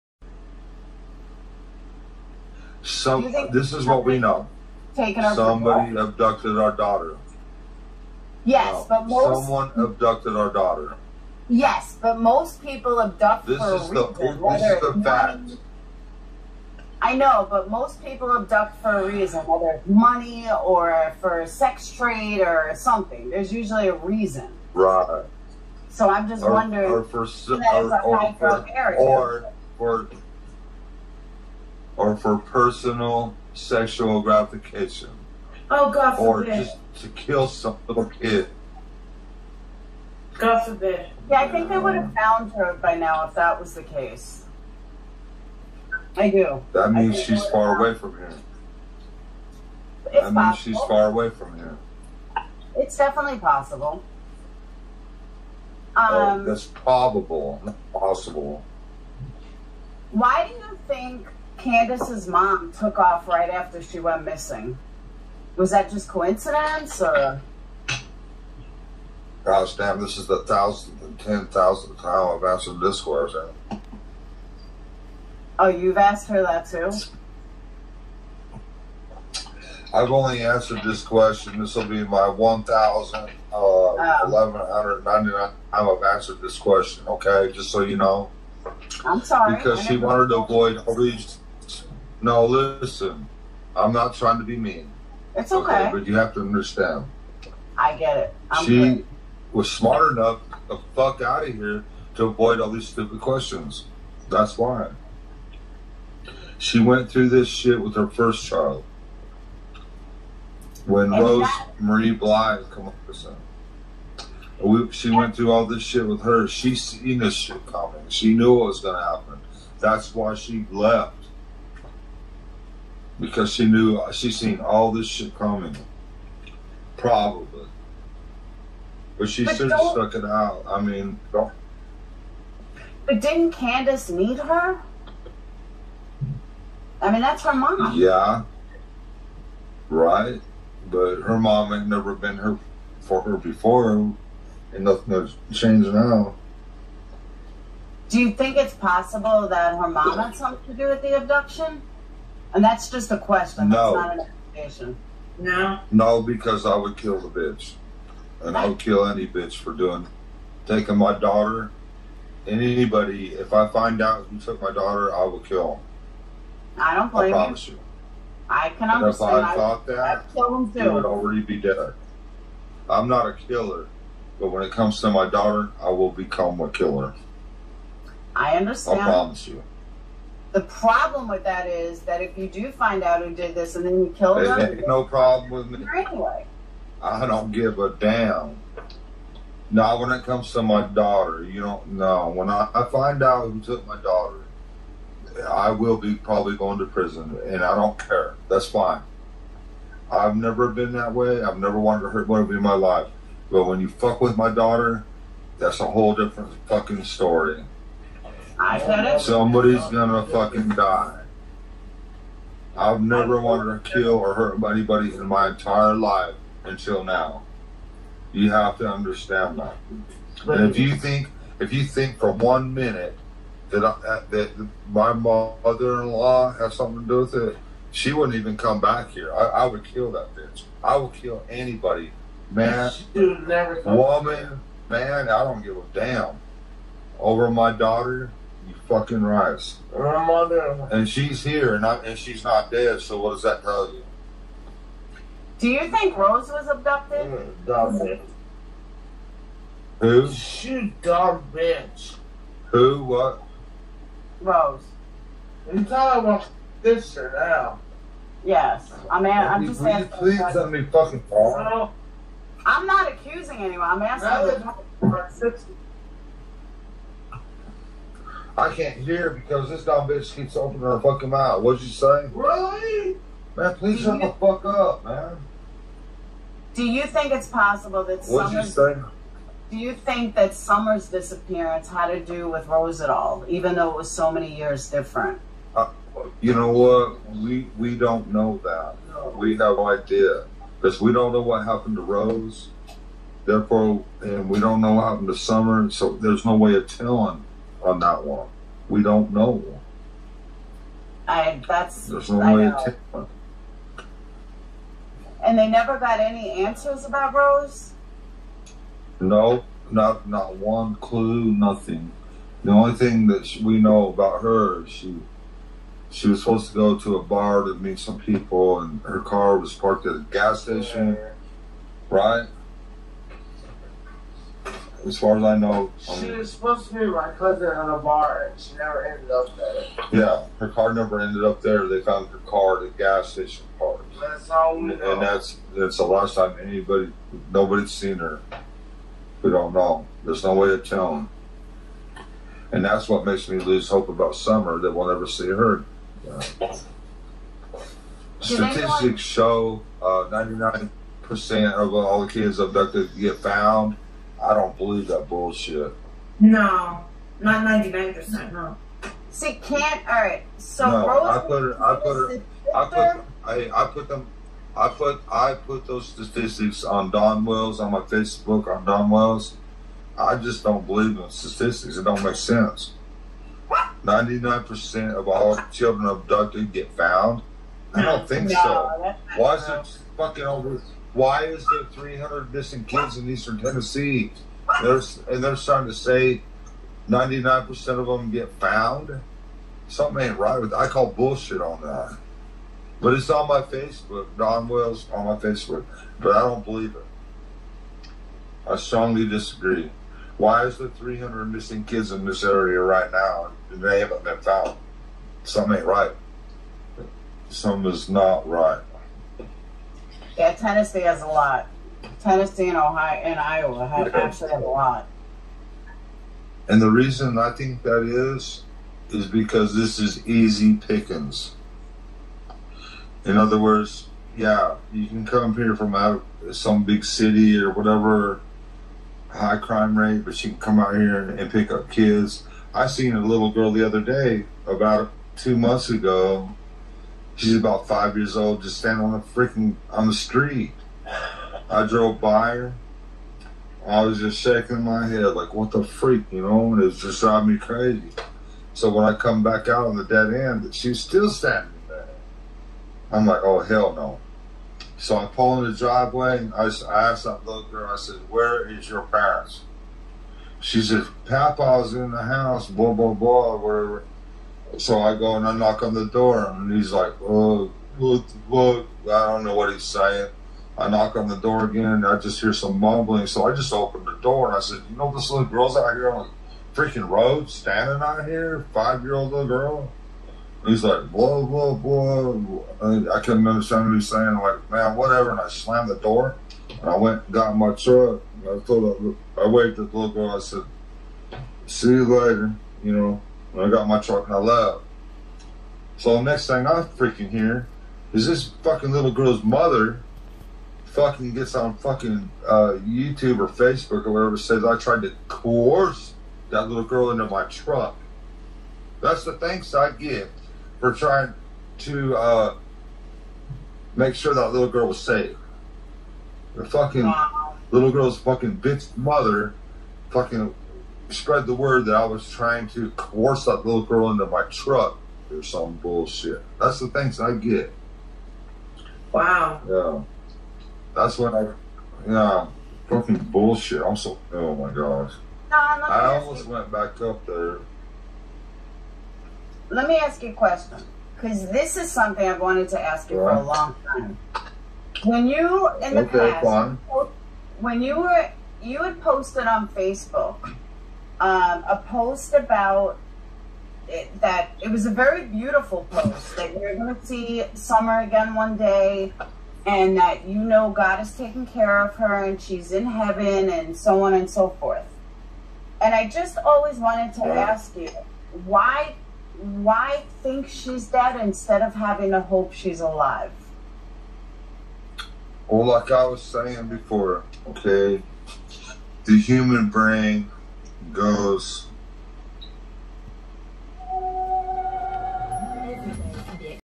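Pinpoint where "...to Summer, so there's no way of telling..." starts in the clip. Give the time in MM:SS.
04:55.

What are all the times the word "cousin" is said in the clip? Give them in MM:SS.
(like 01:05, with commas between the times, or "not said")
05:27.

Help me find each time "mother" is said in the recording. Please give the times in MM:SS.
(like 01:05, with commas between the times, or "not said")
03:45, 08:19, 08:38.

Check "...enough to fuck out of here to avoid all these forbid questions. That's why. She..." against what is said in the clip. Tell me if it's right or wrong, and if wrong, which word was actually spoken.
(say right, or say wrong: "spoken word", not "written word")
wrong: "stupid", not "forbid".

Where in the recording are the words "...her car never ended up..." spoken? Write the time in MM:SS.
05:30.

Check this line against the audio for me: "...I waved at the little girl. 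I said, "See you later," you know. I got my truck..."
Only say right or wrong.
right.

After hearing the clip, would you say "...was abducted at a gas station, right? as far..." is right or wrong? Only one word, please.
wrong.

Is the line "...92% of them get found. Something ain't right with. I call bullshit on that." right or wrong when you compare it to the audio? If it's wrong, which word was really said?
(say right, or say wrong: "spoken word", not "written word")
wrong: "99", not "92".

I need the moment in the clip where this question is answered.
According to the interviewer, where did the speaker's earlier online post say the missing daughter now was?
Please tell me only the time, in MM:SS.
09:22.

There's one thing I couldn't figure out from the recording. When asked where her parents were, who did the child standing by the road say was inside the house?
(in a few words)
Papa.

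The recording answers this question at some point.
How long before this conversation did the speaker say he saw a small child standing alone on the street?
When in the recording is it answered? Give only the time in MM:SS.
07:15.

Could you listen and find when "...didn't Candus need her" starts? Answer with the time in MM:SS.
02:13.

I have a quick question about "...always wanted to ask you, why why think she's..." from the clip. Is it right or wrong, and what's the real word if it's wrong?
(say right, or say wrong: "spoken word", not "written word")
right.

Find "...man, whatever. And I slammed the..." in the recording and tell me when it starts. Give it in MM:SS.
08:04.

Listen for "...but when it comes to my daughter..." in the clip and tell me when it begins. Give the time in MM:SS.
02:54.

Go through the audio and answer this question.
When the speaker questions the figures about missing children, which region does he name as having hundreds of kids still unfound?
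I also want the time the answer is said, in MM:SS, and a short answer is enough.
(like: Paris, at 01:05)
Eastern Tennessee, at 06:23.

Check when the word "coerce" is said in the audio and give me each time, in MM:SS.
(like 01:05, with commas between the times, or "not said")
08:25, 08:42.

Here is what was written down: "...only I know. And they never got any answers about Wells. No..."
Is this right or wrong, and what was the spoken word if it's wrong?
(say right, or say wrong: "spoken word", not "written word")
wrong: "Rose", not "Wells".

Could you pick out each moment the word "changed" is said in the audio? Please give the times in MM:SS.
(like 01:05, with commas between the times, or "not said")
02:25.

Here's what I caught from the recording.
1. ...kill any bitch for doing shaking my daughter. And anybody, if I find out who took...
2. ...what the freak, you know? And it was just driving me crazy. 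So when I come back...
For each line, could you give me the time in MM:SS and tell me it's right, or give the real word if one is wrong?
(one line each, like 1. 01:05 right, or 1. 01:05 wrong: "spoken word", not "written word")
1. 02:38 wrong: "taking", not "shaking"
2. 07:25 right.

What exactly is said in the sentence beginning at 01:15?
Oh, you've asked her that too?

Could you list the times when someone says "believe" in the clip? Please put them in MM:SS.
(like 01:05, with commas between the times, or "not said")
05:54, 06:10, 06:36.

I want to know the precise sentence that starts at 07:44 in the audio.
So I go and I knock on the door, and he's like, "Oh, what, what?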